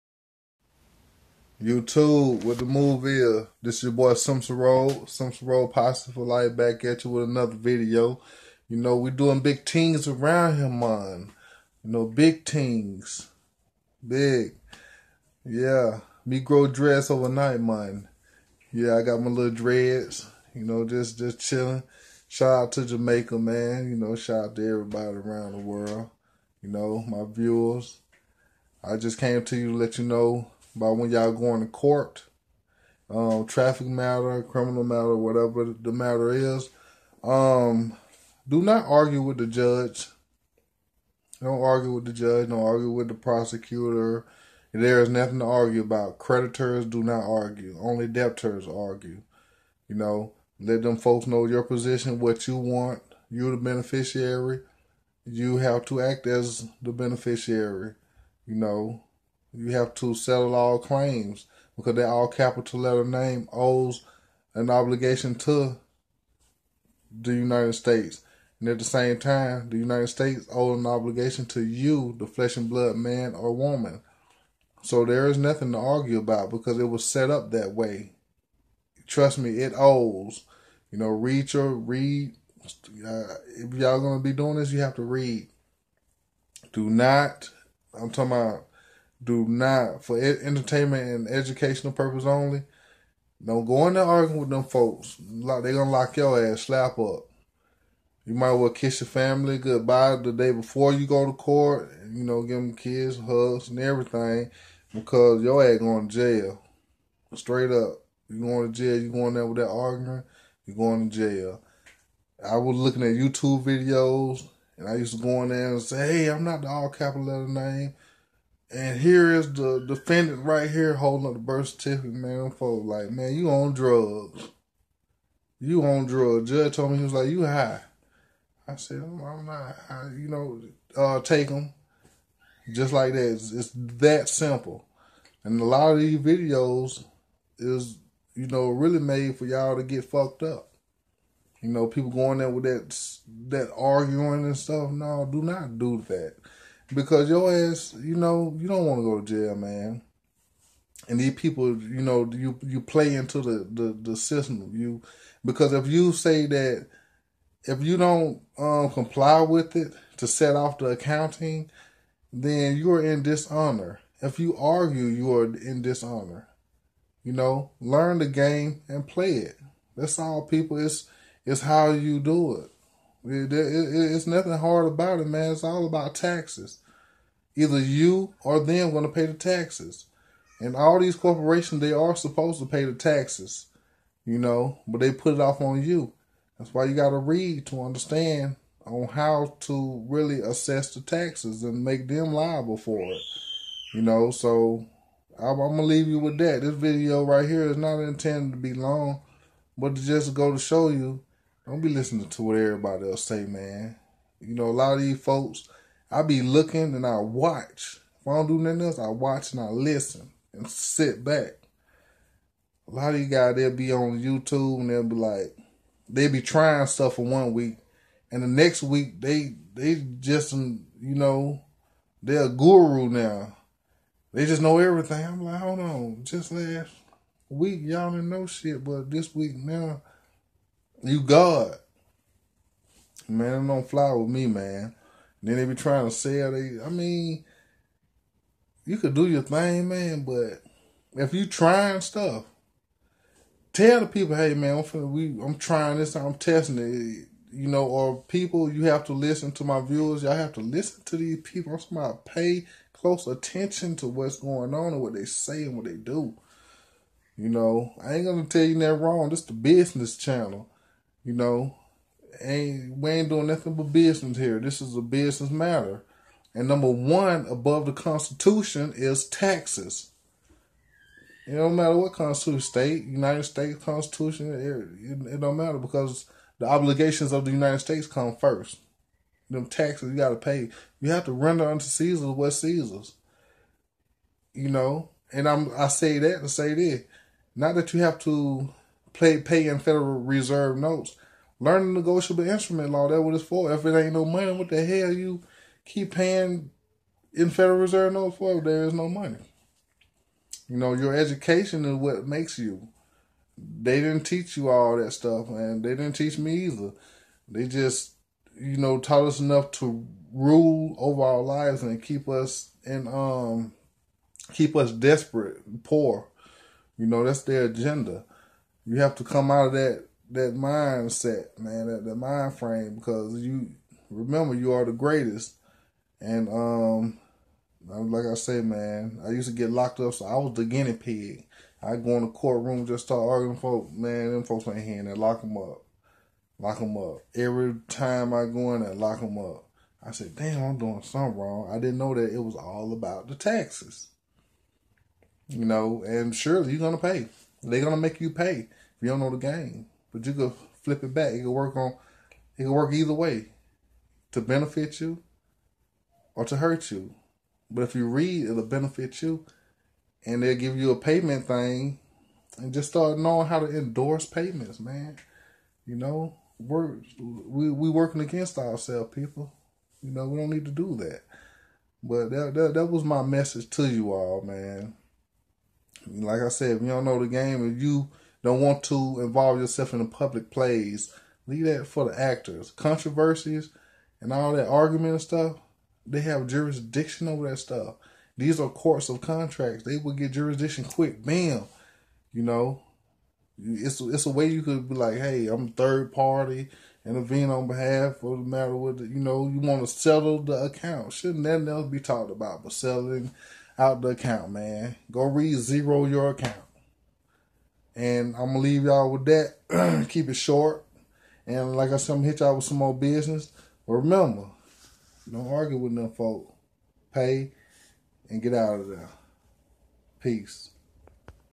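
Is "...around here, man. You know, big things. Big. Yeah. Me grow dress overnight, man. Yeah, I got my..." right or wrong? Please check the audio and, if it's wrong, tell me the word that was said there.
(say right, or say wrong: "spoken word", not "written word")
right.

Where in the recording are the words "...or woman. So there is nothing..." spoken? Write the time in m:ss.
1:13.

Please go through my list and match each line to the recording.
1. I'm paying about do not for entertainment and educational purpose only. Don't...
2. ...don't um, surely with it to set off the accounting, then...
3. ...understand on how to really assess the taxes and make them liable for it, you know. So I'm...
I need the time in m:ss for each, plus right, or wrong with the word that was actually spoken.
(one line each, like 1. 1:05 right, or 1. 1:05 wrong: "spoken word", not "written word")
1. 1:27 wrong: "talking", not "paying"
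2. 2:37 wrong: "comply", not "surely"
3. 3:07 right.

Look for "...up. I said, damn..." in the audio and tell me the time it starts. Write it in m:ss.
5:39.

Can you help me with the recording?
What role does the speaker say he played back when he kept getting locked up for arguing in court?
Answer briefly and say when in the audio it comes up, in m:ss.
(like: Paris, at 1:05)
Guinea pig, at 5:30.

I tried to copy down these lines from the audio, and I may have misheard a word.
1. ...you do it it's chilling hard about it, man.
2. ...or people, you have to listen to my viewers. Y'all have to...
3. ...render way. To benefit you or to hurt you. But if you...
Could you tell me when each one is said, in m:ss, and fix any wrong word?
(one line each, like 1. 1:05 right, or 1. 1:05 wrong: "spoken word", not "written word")
1. 2:51 wrong: "nothing", not "chilling"
2. 4:07 right
3. 5:52 wrong: "either", not "render".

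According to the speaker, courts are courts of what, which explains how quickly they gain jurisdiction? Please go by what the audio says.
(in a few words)
Contracts.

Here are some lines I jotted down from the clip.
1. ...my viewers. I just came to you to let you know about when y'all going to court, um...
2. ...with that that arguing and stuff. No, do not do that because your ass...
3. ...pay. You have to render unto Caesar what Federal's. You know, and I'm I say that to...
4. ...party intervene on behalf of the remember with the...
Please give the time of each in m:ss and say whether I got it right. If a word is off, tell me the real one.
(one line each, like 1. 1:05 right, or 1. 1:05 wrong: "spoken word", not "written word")
1. 0:27 right
2. 2:22 right
3. 4:40 wrong: "Caesar", not "Federal"
4. 6:36 wrong: "matter", not "remember".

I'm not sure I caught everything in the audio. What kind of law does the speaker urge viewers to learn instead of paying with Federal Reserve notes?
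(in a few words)
Negotiable instrument law.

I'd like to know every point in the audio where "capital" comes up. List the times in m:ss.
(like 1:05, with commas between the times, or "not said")
1:02, 1:56.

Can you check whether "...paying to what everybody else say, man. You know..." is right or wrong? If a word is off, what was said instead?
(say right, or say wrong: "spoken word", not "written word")
wrong: "listening", not "paying".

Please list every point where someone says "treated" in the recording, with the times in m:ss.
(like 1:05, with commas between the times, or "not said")
not said.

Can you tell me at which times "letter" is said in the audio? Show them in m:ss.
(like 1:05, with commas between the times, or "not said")
1:02, 1:57.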